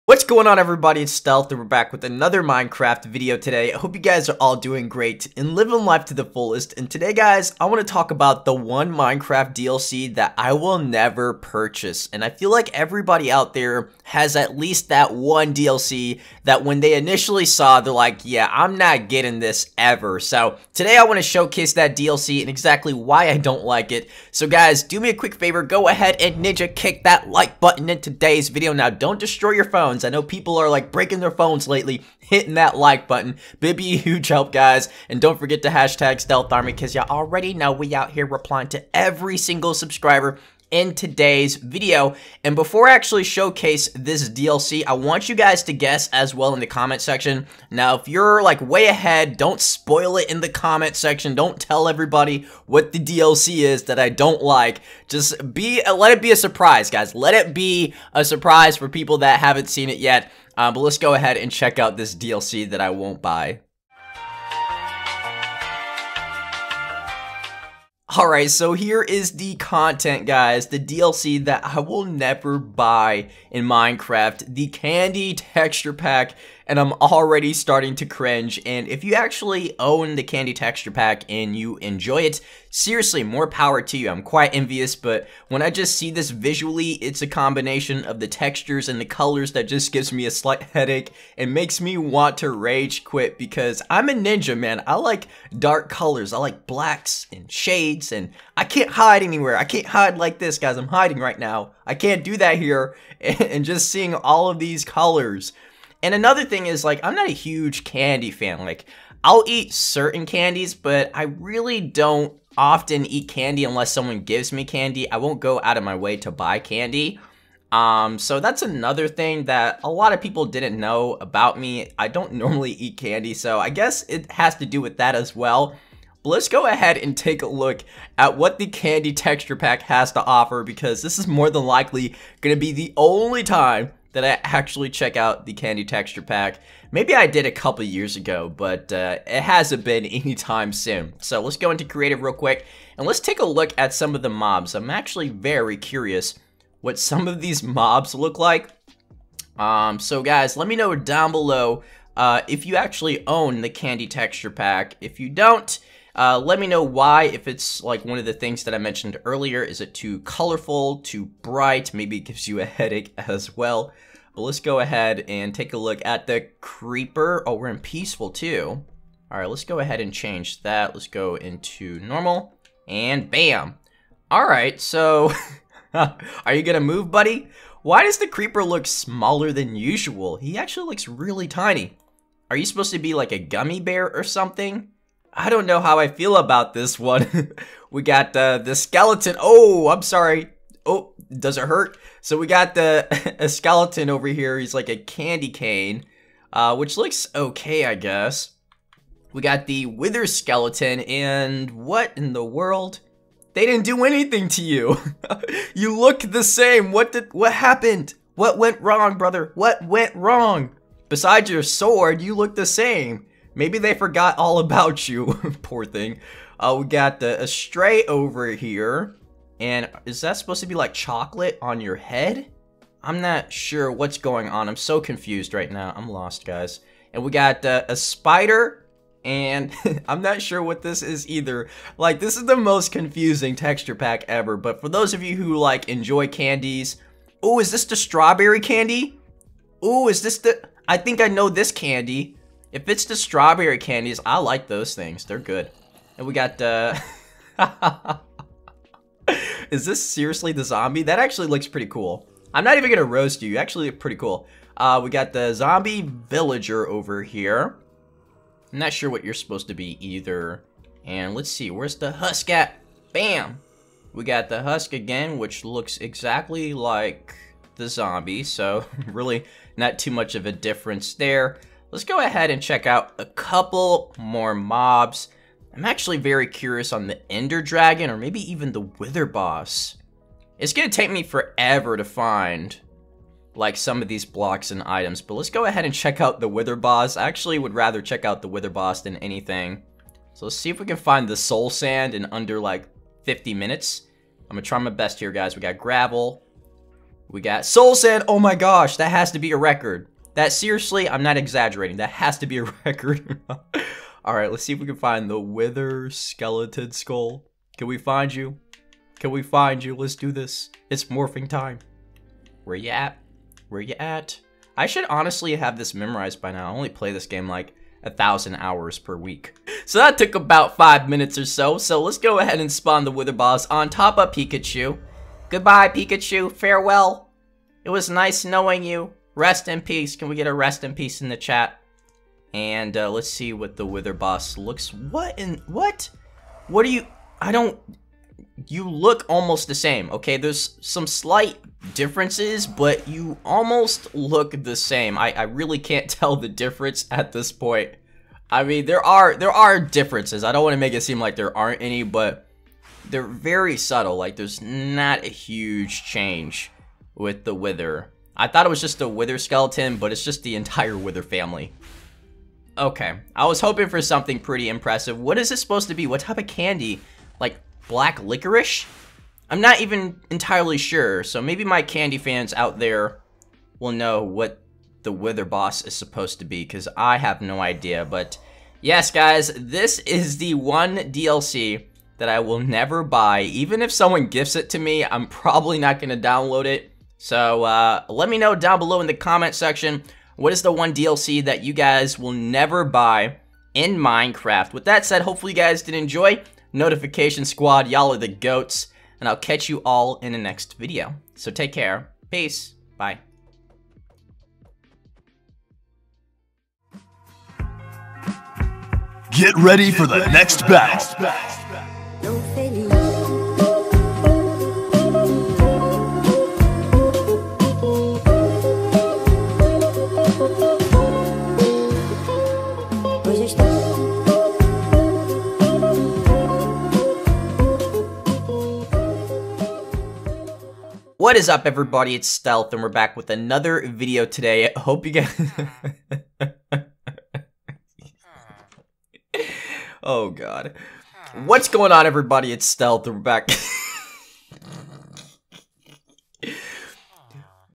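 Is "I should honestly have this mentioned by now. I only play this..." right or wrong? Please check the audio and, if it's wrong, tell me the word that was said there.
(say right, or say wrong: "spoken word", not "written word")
wrong: "memorized", not "mentioned".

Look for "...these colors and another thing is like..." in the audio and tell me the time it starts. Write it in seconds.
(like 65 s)
104 s.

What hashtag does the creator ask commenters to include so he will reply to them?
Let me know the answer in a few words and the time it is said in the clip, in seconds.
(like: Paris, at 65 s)
Stealth Army, at 36 s.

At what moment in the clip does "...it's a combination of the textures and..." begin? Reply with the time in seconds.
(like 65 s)
86 s.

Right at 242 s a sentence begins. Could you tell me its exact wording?
If it's the strawberry candies, I like those things.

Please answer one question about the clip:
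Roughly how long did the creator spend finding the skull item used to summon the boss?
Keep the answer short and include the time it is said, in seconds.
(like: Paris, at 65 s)
About 5 minutes, at 320 s.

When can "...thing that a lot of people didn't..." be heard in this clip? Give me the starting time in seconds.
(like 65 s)
119 s.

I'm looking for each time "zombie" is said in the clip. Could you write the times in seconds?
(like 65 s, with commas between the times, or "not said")
250 s, 255 s, 267 s.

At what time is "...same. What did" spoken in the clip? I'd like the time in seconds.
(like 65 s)
206 s.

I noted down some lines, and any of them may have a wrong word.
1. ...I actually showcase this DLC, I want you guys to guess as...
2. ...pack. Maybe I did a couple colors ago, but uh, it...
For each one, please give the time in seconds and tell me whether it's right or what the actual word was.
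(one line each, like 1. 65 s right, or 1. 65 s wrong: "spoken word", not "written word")
1. 42 s right
2. 136 s wrong: "years", not "colors".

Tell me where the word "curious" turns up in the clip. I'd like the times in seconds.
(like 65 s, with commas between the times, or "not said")
145 s, 276 s.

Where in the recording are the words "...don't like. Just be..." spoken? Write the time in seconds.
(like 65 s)
54 s.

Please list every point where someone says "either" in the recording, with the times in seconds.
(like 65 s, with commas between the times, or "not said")
231 s, 260 s.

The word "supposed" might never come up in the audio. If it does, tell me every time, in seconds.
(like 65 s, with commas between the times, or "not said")
182 s, 220 s, 259 s, 365 s, 375 s.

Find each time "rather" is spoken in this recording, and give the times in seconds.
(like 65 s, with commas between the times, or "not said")
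287 s.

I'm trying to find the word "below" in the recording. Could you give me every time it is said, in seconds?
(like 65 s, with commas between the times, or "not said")
151 s, 388 s.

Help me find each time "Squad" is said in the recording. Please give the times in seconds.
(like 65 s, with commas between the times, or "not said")
397 s.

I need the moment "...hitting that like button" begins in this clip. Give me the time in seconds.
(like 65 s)
32 s.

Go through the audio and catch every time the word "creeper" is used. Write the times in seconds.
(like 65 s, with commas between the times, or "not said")
166 s, 178 s.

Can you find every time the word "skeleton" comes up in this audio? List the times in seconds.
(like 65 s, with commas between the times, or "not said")
188 s, 193 s, 200 s, 306 s, 359 s.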